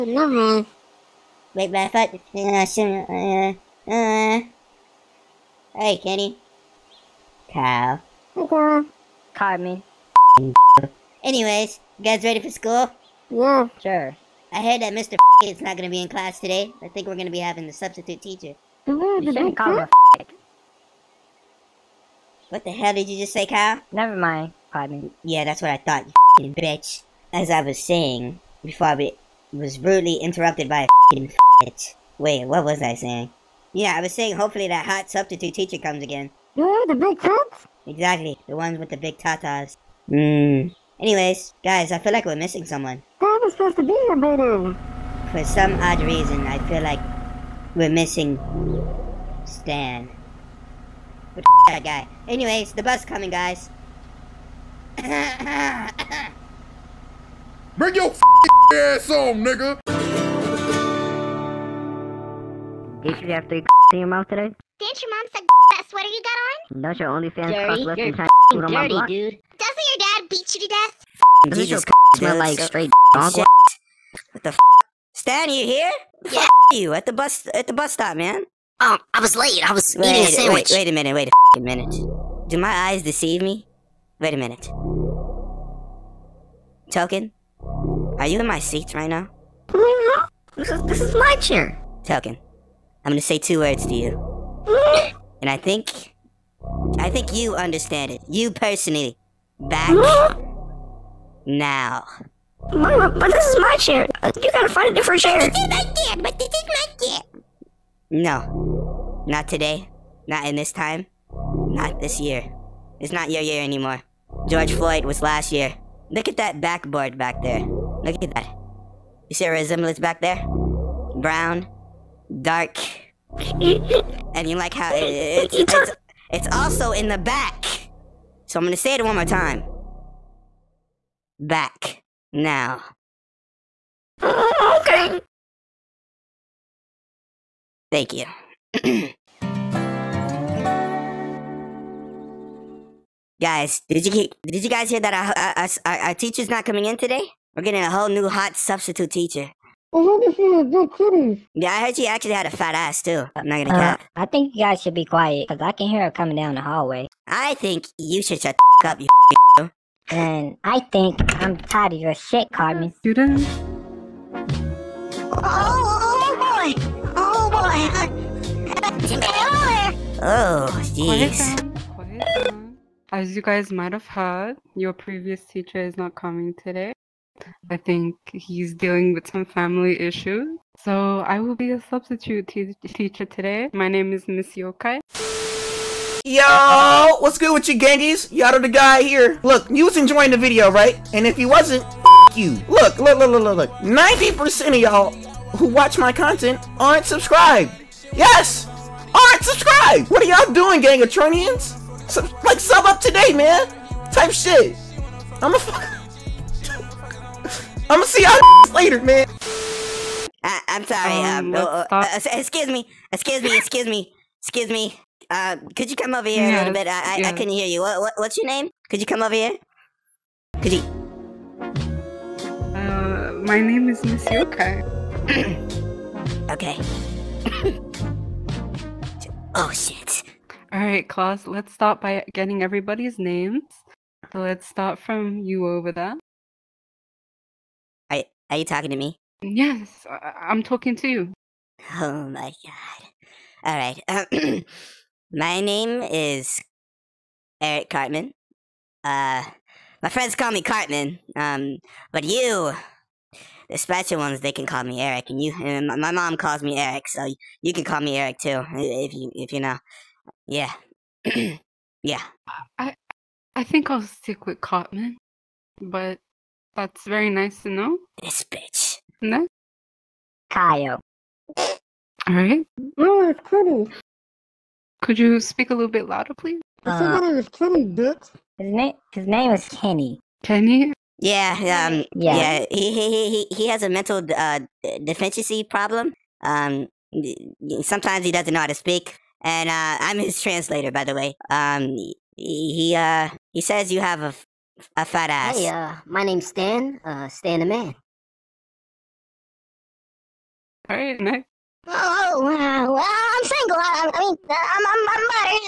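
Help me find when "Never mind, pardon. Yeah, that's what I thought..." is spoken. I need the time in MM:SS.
00:23.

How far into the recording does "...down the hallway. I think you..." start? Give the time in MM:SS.
02:36.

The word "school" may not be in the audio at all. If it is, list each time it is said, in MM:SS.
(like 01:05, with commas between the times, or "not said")
00:12.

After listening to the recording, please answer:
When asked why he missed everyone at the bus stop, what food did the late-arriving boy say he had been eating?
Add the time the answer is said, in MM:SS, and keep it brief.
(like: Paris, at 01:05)
Sandwich, at 01:20.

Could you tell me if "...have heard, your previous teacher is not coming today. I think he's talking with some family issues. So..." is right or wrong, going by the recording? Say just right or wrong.
wrong.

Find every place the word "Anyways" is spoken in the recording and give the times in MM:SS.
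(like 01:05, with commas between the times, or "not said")
00:11, 00:40, 00:52.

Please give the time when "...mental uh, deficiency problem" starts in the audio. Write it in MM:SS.
04:43.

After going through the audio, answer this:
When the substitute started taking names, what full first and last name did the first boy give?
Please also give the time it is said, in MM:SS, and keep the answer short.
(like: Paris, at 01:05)
Eric Cartman, at 04:07.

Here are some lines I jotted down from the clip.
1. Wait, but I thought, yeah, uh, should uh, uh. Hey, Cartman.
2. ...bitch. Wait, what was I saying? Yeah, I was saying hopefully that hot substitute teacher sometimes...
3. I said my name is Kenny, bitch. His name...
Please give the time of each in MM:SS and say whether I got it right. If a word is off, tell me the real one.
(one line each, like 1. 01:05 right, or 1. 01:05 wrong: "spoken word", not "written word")
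1. 00:01 wrong: "Kenny", not "Cartman"
2. 00:31 wrong: "comes", not "sometimes"
3. 04:36 right.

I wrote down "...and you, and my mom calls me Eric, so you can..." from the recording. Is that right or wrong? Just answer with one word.
right.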